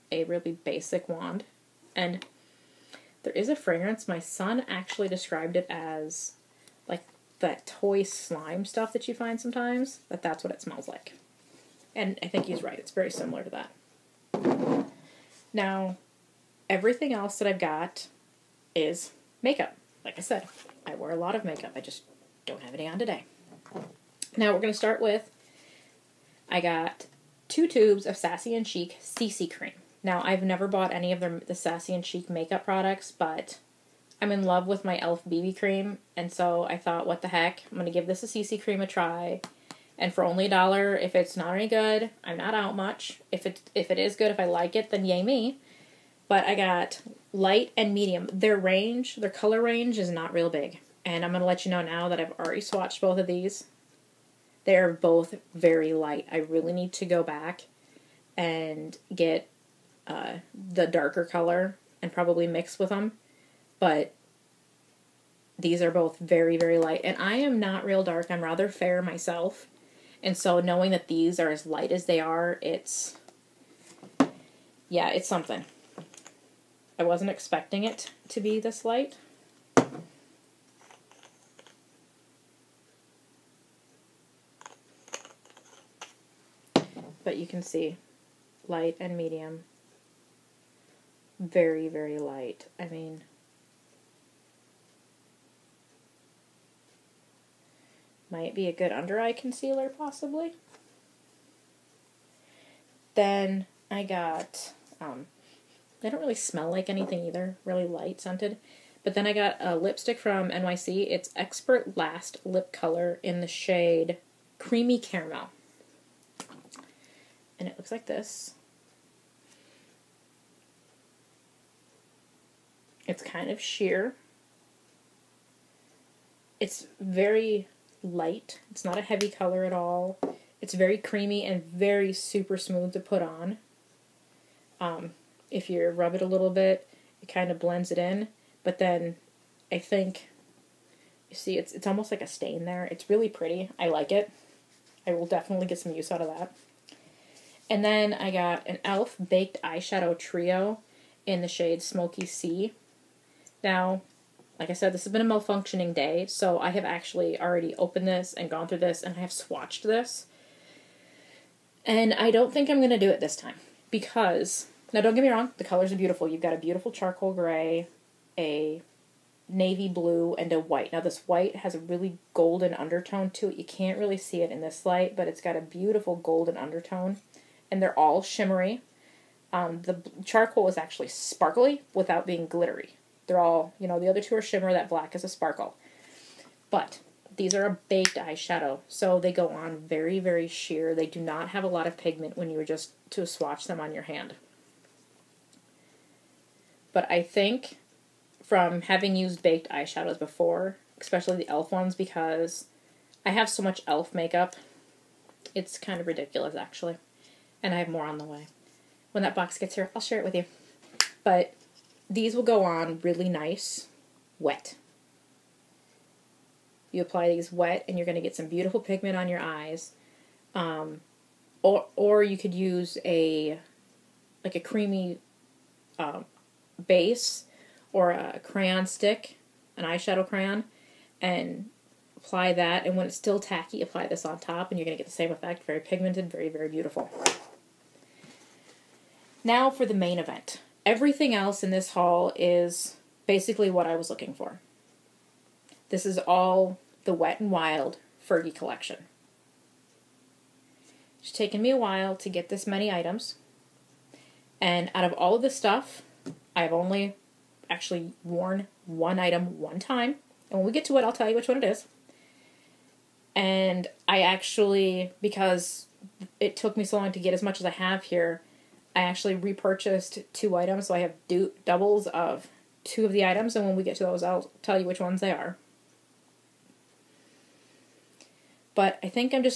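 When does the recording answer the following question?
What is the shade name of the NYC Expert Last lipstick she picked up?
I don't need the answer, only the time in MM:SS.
01:54.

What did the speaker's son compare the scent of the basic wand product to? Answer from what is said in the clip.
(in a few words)
toy slime.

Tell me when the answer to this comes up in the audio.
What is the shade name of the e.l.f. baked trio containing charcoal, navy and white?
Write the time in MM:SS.
02:31.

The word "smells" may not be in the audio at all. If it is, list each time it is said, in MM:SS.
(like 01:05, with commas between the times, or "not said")
00:10, 01:46.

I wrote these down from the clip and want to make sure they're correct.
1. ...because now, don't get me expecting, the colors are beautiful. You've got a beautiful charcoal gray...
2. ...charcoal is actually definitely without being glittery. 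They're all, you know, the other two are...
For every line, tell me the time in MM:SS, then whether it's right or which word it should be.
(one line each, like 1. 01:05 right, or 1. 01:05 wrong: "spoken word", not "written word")
1. 02:43 wrong: "wrong", not "expecting"
2. 03:00 wrong: "sparkly", not "definitely".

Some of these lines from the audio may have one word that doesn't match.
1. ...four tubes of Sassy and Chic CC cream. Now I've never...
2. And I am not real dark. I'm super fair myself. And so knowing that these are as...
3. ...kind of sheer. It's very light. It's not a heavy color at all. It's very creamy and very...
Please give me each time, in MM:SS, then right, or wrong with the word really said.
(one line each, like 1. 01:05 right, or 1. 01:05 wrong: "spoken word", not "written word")
1. 00:27 wrong: "two", not "four"
2. 01:07 wrong: "rather", not "super"
3. 02:03 right.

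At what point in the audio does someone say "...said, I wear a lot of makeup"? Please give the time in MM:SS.
00:20.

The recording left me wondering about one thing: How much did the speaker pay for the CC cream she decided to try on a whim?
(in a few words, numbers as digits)
a dollar.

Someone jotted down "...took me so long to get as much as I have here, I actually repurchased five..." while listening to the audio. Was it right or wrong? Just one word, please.
wrong.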